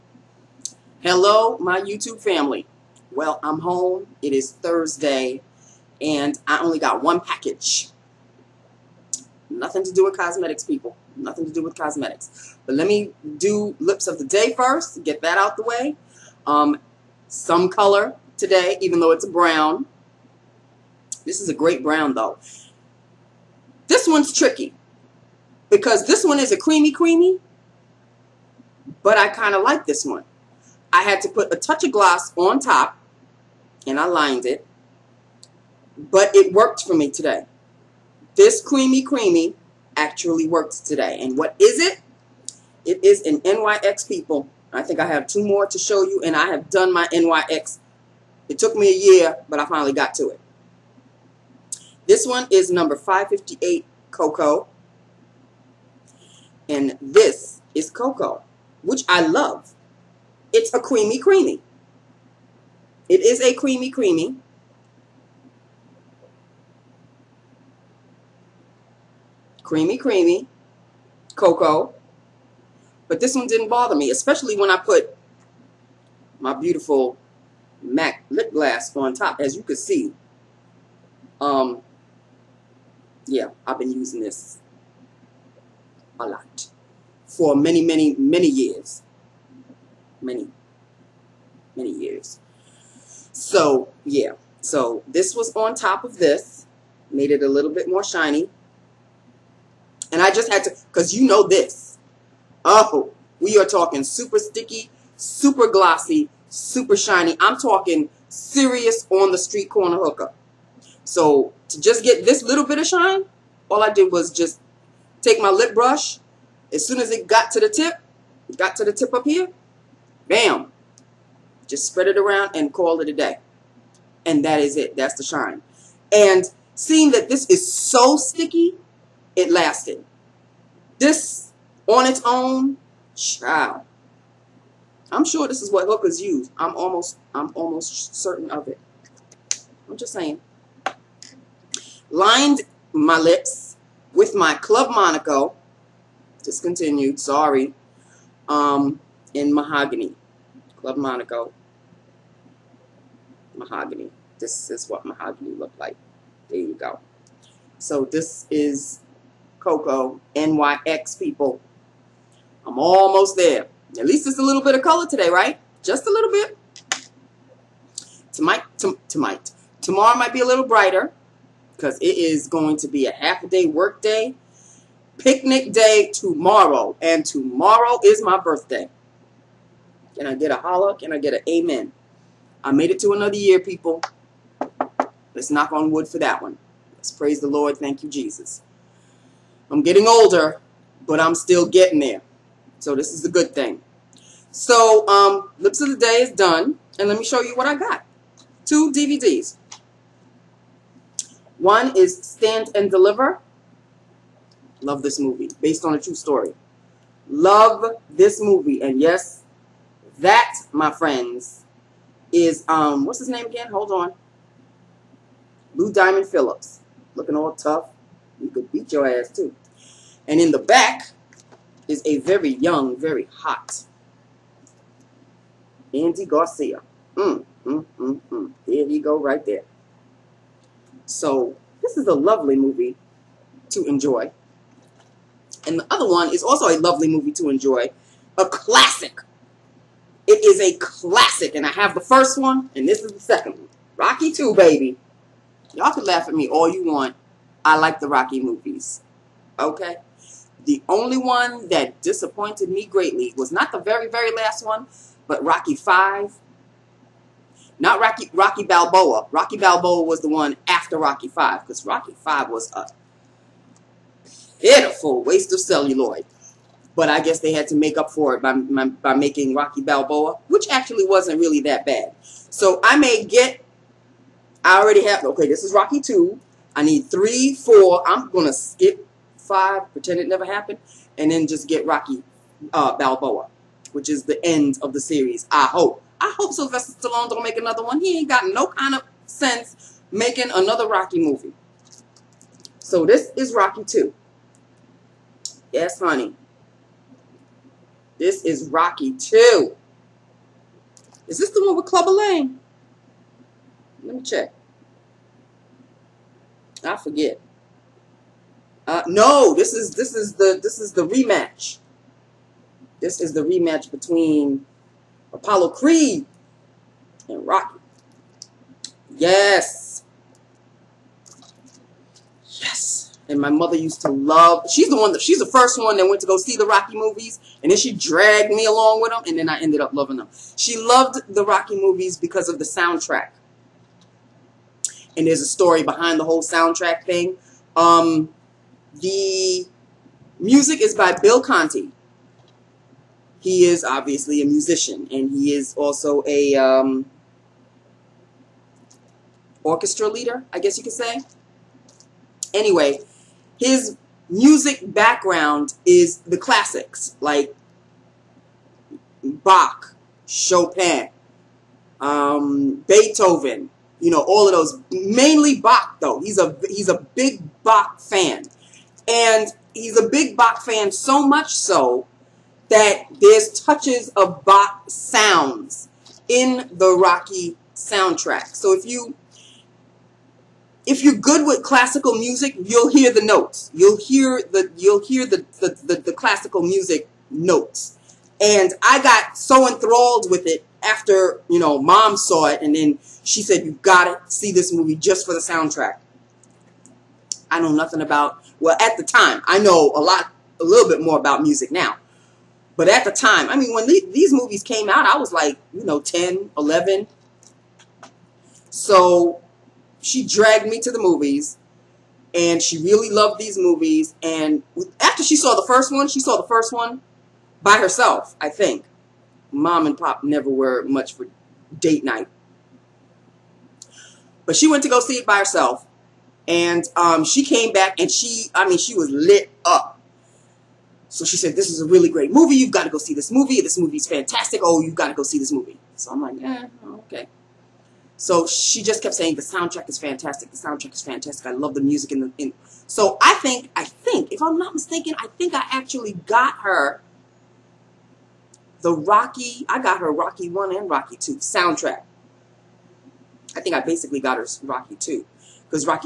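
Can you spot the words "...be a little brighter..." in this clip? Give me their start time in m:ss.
2:50.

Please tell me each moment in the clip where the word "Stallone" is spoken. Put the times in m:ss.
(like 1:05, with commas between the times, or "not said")
4:47.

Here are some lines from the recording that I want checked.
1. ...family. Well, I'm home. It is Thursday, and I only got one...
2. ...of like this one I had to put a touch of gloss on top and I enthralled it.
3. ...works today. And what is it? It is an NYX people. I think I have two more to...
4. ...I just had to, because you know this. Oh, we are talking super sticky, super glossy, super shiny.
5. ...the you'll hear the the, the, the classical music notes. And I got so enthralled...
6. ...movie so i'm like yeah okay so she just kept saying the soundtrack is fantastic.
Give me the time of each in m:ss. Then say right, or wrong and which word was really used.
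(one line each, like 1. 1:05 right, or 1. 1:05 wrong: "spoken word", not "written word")
1. 0:02 right
2. 0:29 wrong: "lined", not "enthralled"
3. 0:40 right
4. 1:40 right
5. 6:24 right
6. 7:15 right.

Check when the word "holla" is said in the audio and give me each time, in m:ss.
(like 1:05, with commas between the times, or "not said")
3:00.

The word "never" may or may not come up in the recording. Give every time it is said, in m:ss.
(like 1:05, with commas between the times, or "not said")
4:40, 7:00.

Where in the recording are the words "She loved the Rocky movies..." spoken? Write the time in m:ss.
5:30.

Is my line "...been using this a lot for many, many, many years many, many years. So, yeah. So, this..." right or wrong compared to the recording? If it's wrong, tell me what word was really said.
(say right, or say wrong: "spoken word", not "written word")
right.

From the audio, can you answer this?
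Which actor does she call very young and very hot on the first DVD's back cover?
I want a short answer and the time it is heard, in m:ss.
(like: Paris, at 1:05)
Andy Garcia, at 3:45.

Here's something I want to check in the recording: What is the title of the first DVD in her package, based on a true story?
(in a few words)
Stand and Deliver.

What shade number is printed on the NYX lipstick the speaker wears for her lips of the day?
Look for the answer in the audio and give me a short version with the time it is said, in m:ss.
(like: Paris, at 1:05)
558, at 0:52.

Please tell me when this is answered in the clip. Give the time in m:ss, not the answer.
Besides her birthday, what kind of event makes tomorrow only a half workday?
2:55.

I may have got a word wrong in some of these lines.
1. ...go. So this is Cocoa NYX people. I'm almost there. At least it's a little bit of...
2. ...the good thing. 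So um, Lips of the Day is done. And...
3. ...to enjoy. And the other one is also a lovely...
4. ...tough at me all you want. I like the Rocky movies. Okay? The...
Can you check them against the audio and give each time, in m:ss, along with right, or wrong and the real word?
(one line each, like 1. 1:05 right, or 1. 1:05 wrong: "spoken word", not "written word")
1. 2:36 right
2. 3:13 right
3. 3:53 right
4. 4:06 wrong: "laugh", not "tough".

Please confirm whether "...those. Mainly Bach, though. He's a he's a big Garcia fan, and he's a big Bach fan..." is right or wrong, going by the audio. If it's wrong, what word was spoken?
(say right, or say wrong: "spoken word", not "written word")
wrong: "Bach", not "Garcia".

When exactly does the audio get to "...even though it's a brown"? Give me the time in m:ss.
0:18.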